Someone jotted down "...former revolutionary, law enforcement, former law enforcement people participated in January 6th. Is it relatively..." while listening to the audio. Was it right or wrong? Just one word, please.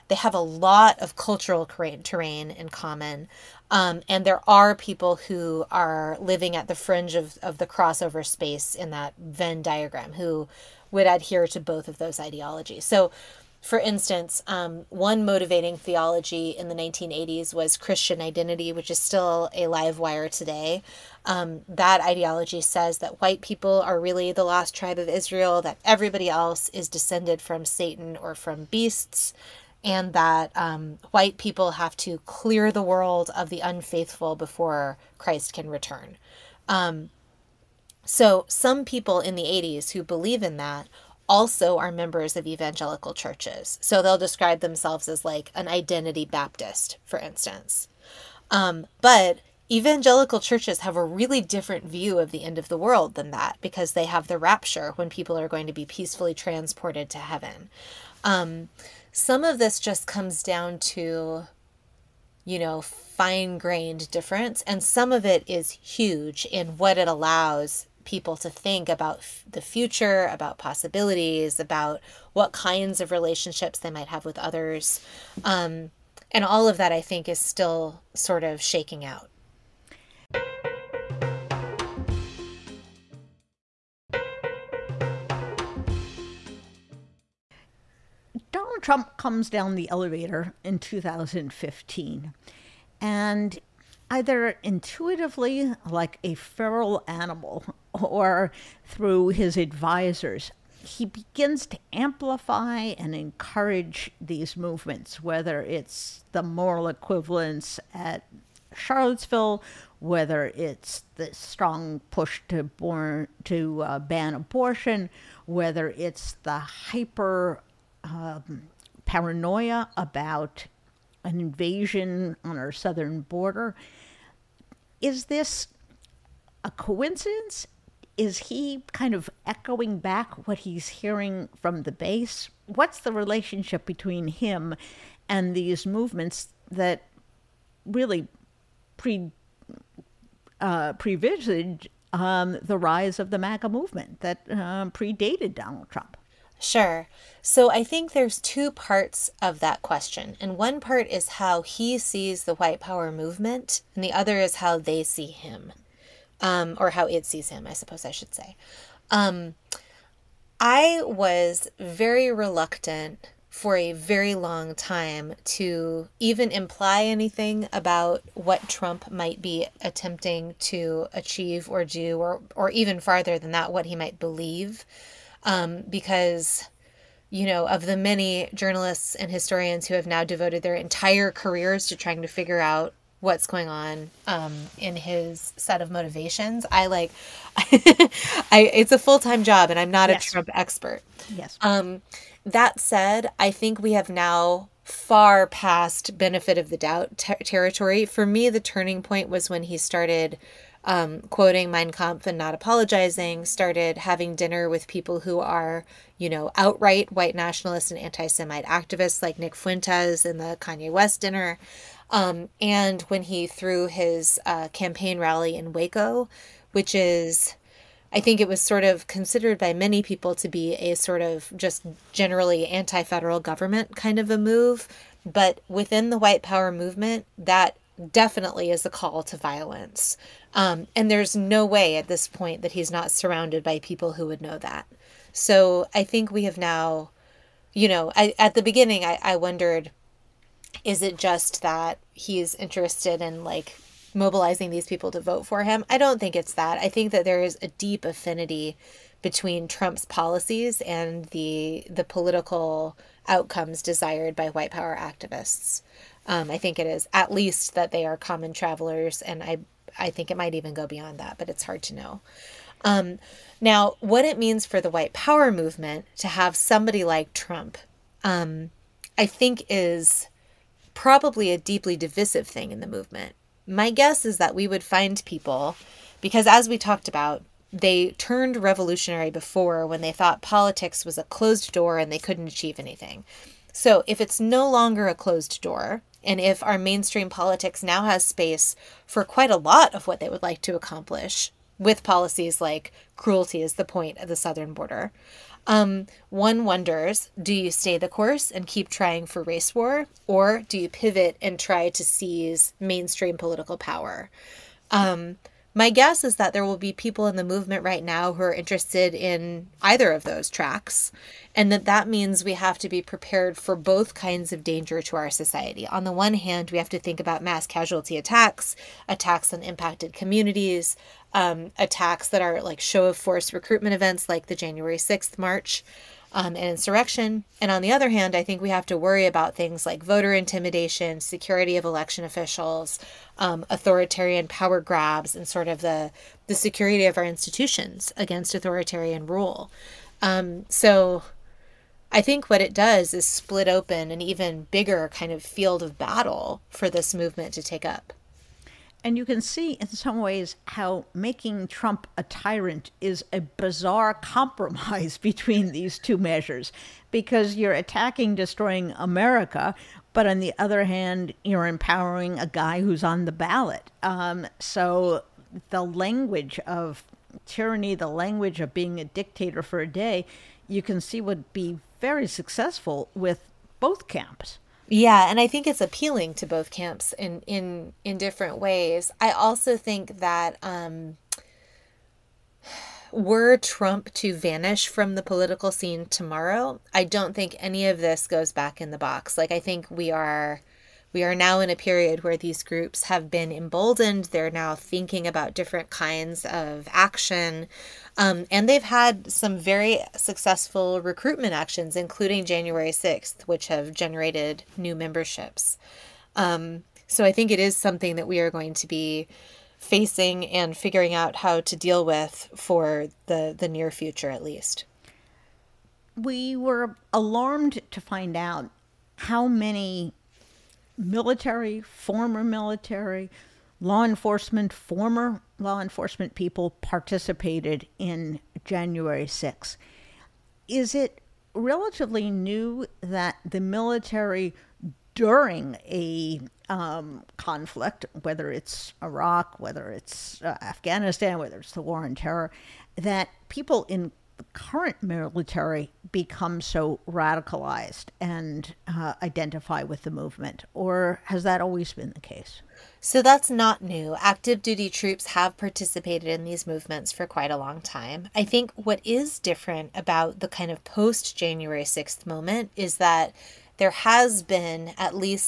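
wrong.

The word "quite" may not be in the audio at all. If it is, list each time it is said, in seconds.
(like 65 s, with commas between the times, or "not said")
289 s, 457 s.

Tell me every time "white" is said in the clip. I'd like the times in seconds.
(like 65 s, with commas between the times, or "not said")
23 s, 31 s, 152 s, 207 s, 226 s, 254 s, 264 s.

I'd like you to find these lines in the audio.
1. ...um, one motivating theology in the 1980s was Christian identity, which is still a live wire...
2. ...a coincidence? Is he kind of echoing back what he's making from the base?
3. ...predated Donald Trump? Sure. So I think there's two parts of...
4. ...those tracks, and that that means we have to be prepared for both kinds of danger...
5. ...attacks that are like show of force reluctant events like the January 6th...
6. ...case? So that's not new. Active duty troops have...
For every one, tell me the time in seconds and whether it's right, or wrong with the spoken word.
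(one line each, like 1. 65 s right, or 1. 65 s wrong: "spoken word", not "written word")
1. 14 s right
2. 126 s wrong: "hearing", not "making"
3. 144 s right
4. 310 s right
5. 321 s wrong: "recruitment", not "reluctant"
6. 452 s right.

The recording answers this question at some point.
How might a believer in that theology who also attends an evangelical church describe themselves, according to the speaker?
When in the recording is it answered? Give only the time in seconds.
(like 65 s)
45 s.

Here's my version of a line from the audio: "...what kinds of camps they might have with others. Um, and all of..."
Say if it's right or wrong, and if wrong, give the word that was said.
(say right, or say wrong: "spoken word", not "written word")
wrong: "relationships", not "camps".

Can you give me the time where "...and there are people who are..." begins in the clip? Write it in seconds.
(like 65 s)
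4 s.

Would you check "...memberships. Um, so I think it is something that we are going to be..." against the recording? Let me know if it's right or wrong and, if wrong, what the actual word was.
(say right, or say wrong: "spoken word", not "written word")
right.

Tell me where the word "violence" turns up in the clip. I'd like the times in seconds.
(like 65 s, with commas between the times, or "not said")
229 s.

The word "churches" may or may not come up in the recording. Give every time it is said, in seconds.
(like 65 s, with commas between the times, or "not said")
43 s, 50 s.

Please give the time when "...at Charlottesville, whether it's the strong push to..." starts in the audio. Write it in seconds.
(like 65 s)
107 s.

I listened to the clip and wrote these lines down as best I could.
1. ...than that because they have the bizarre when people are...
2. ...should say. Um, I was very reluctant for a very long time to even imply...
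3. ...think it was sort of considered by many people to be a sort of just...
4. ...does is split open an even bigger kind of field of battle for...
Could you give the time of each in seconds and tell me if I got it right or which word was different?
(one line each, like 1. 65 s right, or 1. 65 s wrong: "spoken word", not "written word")
1. 53 s wrong: "rapture", not "bizarre"
2. 158 s right
3. 218 s right
4. 342 s right.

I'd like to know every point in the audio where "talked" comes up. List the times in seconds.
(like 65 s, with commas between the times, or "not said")
276 s.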